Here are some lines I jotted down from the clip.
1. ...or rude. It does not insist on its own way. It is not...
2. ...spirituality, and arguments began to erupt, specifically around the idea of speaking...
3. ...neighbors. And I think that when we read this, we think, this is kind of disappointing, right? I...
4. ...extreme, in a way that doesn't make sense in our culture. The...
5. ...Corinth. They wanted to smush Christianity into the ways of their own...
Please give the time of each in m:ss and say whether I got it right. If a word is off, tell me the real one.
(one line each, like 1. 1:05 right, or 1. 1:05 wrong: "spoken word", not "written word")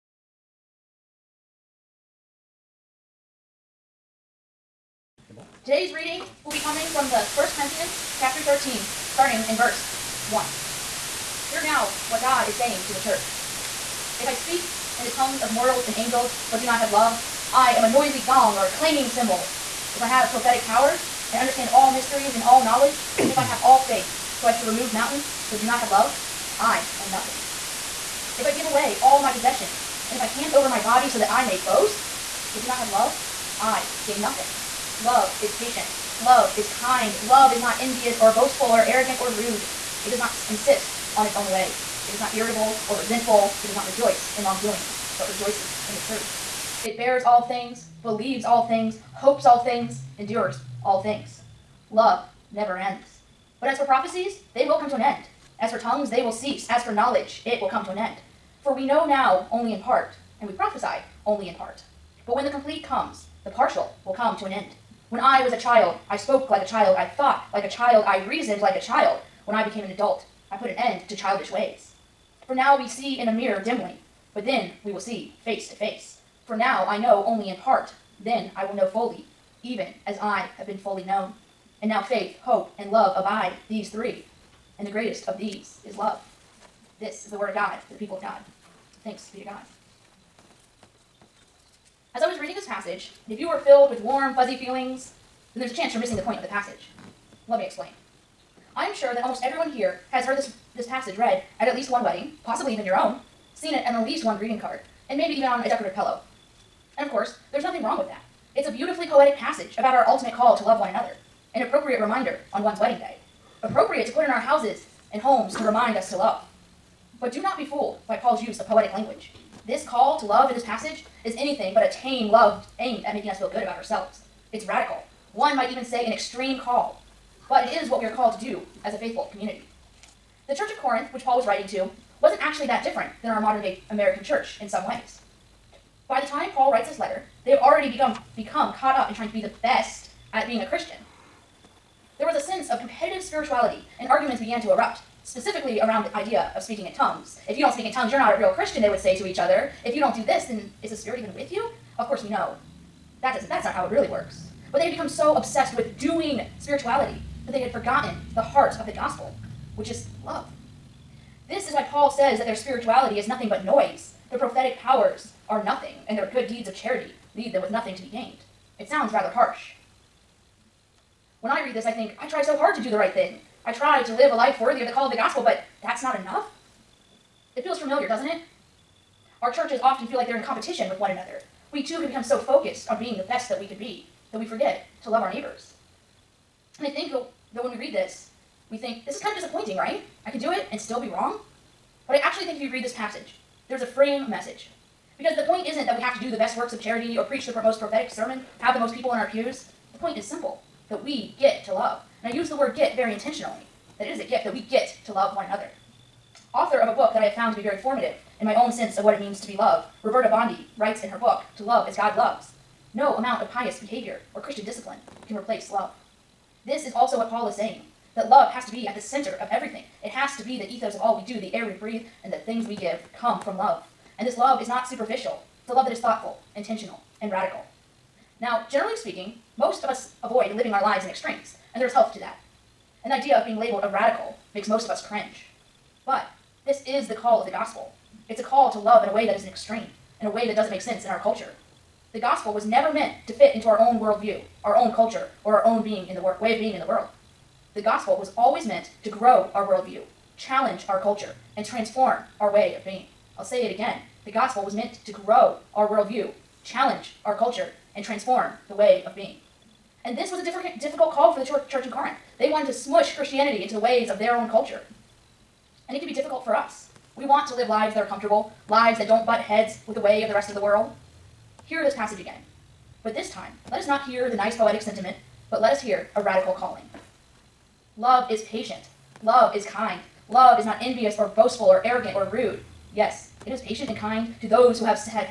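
1. 0:39 right
2. 2:23 right
3. 3:05 right
4. 3:59 right
5. 4:21 right.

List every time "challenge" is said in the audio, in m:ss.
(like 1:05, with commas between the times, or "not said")
4:10, 4:16.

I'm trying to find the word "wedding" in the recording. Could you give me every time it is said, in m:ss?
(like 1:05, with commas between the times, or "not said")
1:42, 1:52.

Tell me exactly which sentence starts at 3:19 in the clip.
The point is simple that we get to love.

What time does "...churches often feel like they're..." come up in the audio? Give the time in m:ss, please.
2:59.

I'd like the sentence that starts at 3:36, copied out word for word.
This is also what Paul is saying that love has to be at the center of everything.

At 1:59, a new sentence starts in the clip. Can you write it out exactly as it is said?
This call to love in this passage is anything but a tame love aimed at making us feel good about ourselves.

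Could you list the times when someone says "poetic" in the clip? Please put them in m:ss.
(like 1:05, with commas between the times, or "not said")
1:49, 1:58, 4:34.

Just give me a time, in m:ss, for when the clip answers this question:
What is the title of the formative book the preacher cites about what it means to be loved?
3:31.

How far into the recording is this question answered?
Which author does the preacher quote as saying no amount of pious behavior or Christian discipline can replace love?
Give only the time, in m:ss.
3:30.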